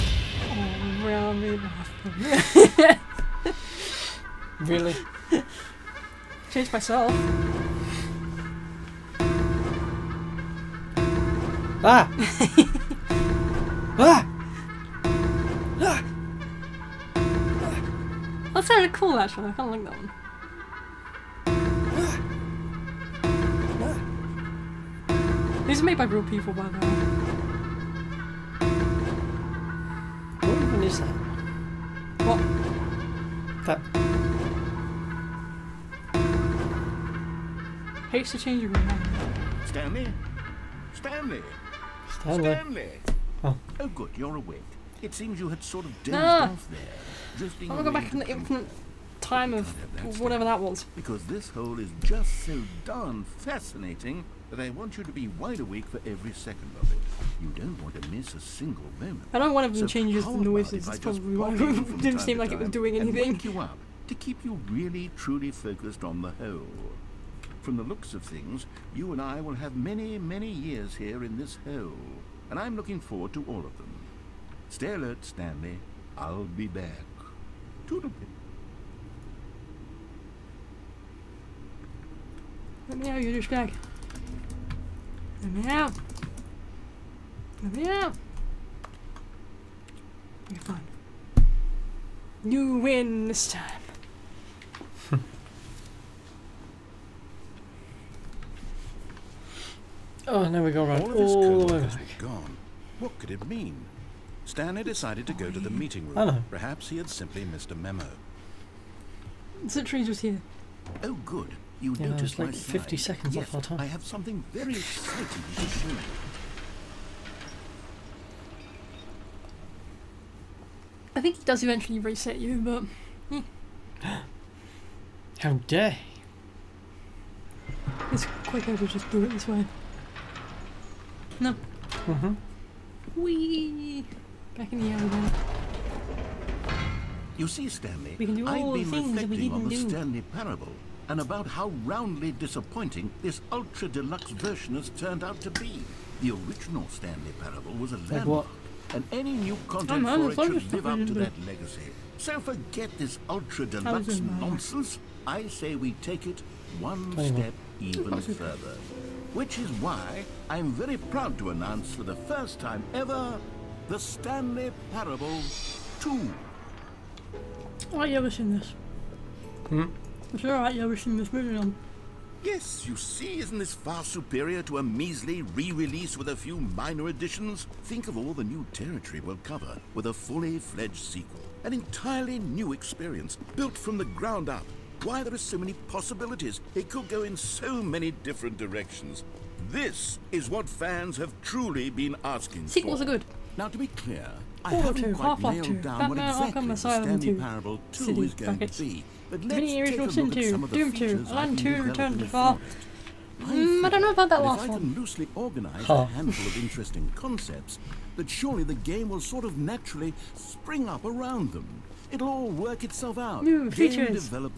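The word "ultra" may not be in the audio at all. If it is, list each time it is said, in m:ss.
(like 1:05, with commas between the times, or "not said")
2:23, 2:33.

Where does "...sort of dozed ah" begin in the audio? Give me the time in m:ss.
0:45.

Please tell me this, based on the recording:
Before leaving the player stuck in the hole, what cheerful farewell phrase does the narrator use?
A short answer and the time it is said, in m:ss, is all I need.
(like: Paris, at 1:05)
Toodle-pip, at 1:17.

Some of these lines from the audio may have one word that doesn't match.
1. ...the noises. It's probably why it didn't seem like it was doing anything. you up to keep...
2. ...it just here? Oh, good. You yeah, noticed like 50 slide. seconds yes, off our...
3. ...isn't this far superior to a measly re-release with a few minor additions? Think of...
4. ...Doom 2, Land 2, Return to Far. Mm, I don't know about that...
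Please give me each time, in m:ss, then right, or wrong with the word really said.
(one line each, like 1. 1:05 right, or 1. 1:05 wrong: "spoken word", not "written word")
1. 1:00 right
2. 1:49 right
3. 2:53 right
4. 3:20 right.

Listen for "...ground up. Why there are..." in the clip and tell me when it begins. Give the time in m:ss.
3:04.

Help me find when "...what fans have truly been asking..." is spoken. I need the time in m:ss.
3:10.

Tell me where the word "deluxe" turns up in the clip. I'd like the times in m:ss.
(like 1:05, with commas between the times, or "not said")
2:23, 2:33.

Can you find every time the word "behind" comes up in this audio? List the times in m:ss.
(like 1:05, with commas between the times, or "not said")
not said.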